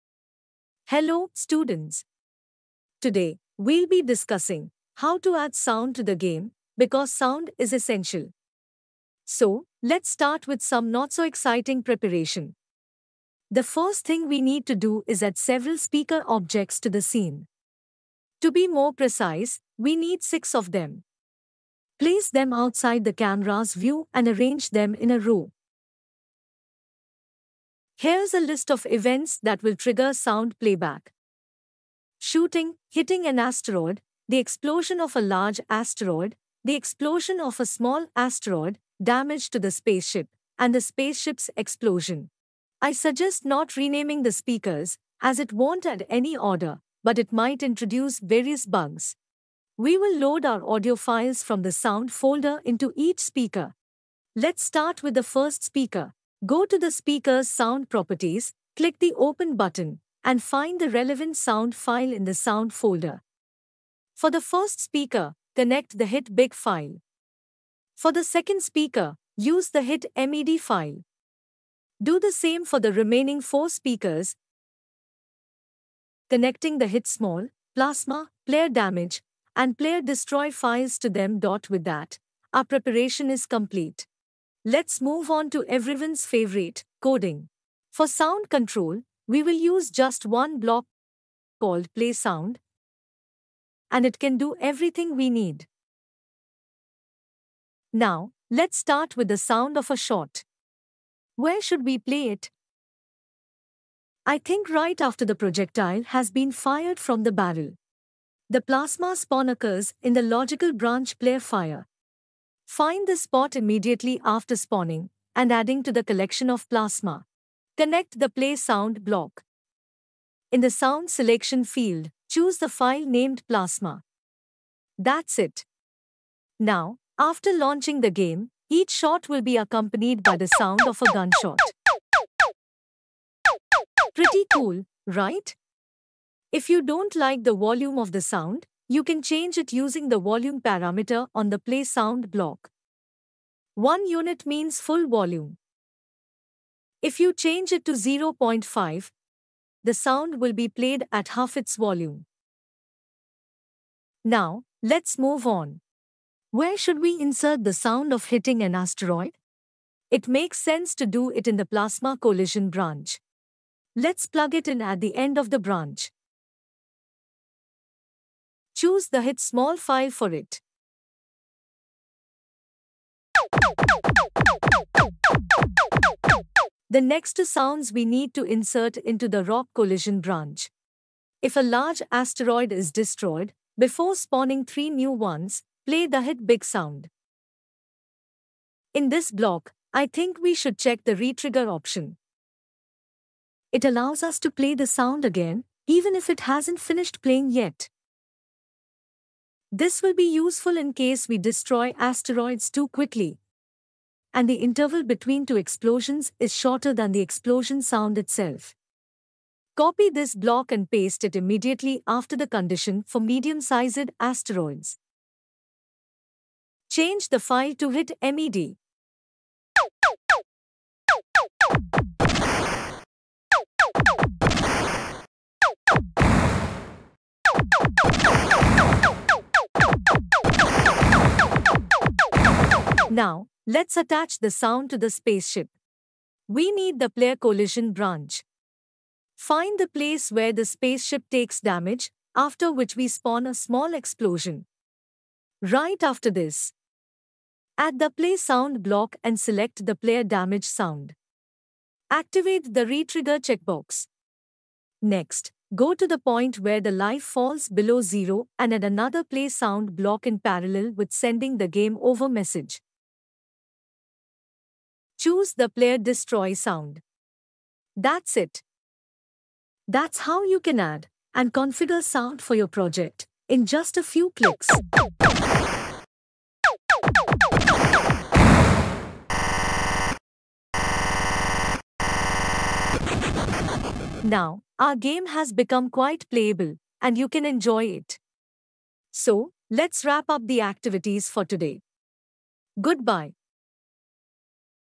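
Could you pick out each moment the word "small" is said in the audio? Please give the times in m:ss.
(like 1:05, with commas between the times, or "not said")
0:37, 1:17, 2:49, 4:03.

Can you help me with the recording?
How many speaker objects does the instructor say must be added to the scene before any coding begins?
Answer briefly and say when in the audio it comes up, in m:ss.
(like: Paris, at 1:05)
6, at 0:20.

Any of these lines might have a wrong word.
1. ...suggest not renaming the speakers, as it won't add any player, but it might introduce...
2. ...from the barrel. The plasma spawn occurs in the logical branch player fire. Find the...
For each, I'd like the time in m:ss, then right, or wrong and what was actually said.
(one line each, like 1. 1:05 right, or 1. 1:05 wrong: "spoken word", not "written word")
1. 0:42 wrong: "order", not "player"
2. 1:46 right.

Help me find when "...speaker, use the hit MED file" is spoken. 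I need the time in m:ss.
1:08.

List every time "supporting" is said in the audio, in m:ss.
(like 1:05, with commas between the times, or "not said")
not said.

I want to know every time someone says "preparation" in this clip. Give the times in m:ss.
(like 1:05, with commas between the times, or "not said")
0:11, 1:22.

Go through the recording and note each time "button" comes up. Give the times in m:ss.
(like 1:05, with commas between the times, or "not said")
0:59.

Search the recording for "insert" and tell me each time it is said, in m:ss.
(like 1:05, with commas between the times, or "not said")
2:37, 2:58.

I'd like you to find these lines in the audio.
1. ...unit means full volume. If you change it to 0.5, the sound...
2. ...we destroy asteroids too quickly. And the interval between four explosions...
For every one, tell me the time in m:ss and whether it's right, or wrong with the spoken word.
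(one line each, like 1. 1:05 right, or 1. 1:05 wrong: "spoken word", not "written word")
1. 2:24 right
2. 3:21 wrong: "two", not "four".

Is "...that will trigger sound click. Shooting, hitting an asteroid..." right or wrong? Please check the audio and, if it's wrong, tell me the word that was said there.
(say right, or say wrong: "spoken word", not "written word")
wrong: "playback", not "click".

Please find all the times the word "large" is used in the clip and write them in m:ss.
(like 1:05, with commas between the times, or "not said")
0:35, 3:01.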